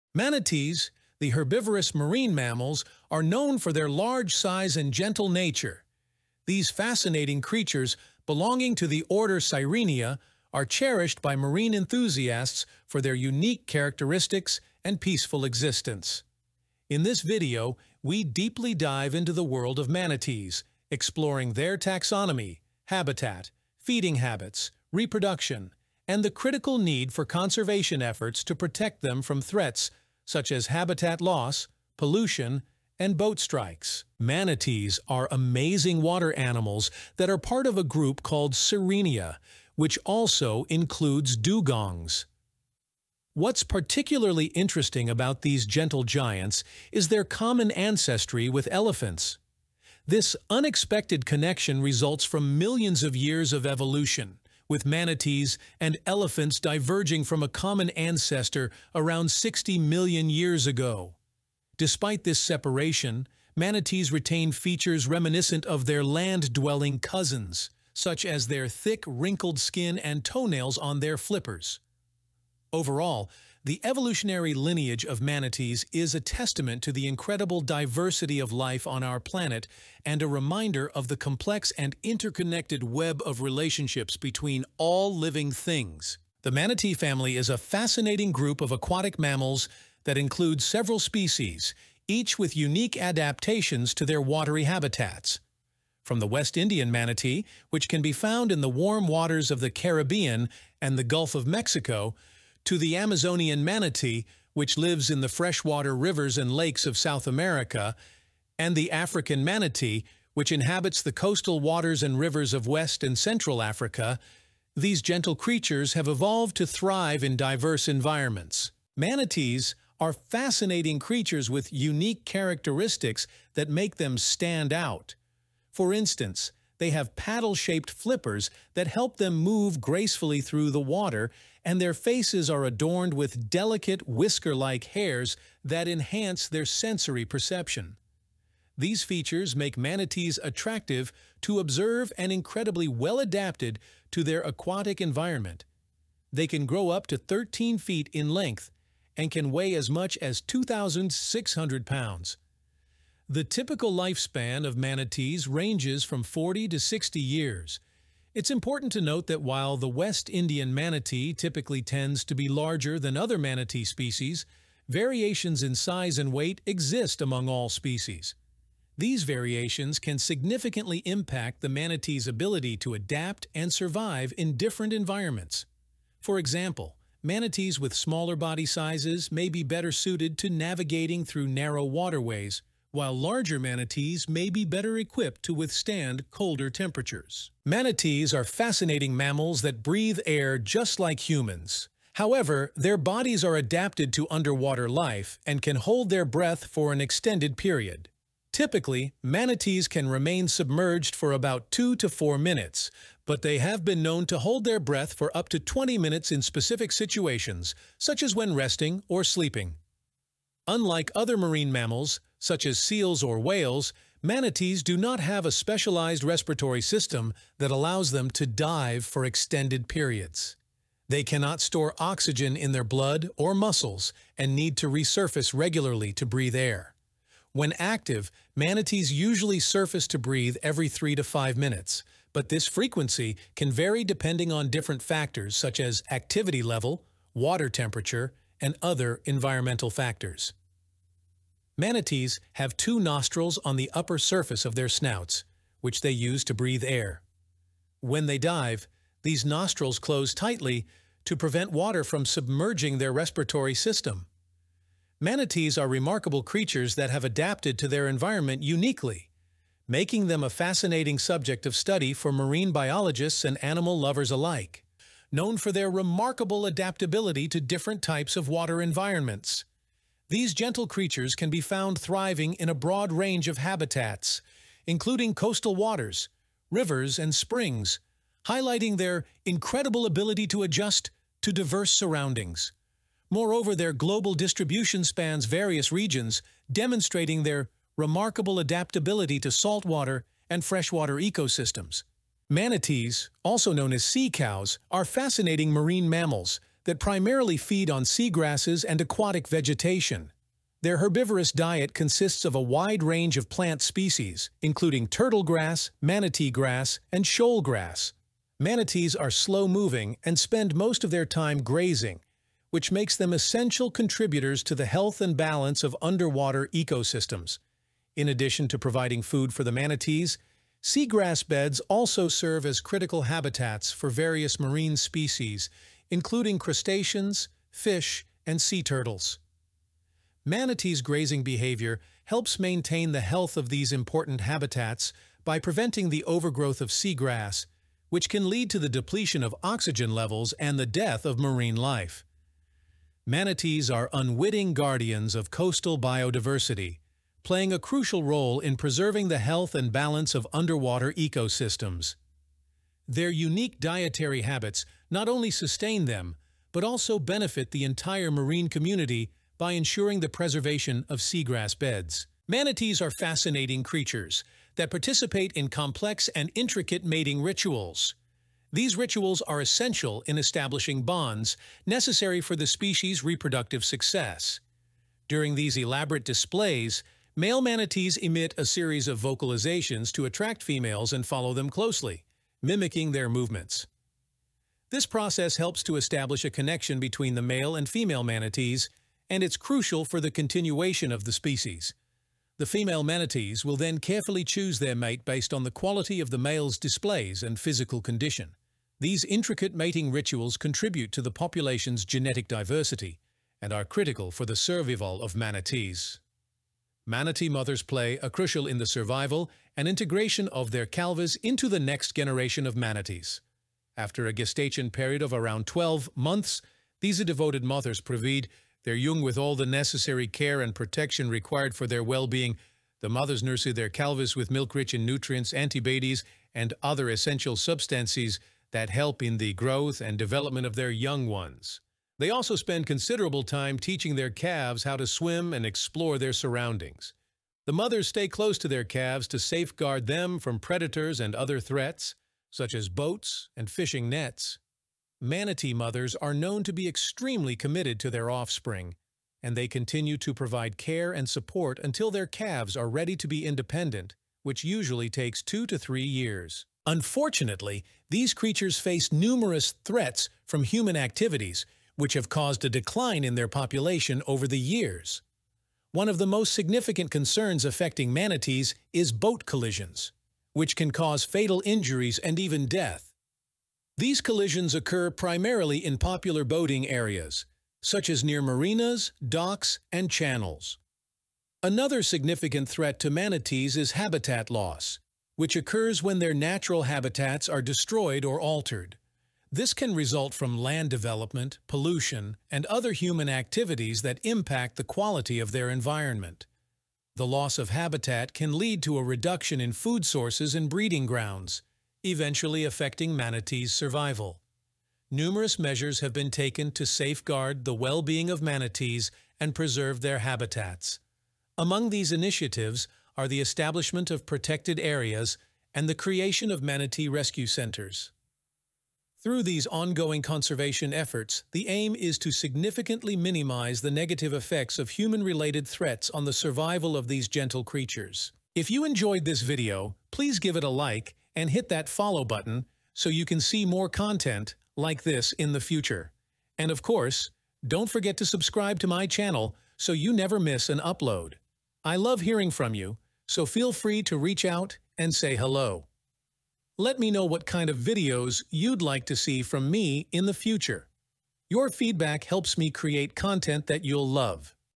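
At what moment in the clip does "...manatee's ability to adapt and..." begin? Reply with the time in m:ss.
2:51.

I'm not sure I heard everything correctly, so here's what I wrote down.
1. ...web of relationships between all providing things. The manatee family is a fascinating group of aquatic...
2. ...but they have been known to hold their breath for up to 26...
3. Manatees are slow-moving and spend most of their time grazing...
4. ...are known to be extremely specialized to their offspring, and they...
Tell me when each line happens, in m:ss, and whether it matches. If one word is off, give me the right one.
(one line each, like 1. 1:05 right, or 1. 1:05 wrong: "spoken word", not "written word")
1. 1:22 wrong: "living", not "providing"
2. 3:23 wrong: "20", not "26"
3. 5:08 right
4. 7:26 wrong: "committed", not "specialized".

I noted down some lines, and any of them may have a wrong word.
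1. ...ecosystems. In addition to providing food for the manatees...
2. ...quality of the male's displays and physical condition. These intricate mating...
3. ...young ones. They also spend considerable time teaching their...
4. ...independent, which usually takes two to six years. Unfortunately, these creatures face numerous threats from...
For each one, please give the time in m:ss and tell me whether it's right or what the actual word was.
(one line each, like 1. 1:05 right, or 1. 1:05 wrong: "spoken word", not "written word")
1. 5:16 right
2. 6:35 right
3. 7:10 right
4. 7:33 wrong: "three", not "six".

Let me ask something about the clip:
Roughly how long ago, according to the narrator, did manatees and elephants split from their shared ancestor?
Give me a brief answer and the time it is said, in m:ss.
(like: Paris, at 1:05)
60 million years, at 0:59.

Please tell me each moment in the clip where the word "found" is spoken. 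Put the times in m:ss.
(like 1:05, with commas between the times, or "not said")
1:38, 4:31.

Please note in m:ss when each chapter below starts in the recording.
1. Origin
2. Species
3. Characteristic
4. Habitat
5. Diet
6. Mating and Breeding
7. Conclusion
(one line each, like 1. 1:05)
1. 0:33
2. 1:26
3. 1:58
4. 4:25
5. 4:52
6. 6:02
7. 7:36.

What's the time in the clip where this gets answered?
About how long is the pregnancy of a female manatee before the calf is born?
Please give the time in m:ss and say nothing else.
6:55.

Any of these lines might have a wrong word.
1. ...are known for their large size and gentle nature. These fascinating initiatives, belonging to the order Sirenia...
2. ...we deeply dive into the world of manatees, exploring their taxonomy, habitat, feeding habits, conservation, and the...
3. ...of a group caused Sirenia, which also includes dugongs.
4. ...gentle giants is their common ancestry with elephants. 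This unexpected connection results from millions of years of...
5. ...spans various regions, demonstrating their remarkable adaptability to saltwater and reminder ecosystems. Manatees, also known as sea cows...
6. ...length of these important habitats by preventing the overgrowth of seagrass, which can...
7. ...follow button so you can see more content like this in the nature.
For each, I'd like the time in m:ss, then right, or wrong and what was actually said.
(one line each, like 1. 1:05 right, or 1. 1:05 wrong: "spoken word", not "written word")
1. 0:03 wrong: "creatures", not "initiatives"
2. 0:18 wrong: "reproduction", not "conservation"
3. 0:37 wrong: "called", not "caused"
4. 0:45 right
5. 4:45 wrong: "freshwater", not "reminder"
6. 5:33 wrong: "health", not "length"
7. 8:51 wrong: "future", not "nature".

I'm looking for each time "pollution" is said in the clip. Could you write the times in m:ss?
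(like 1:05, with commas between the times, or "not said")
0:31, 8:11.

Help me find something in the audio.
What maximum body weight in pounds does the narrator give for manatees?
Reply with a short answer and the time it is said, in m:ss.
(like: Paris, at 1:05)
2,600 pounds, at 2:30.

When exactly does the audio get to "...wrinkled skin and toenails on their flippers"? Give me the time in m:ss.
1:09.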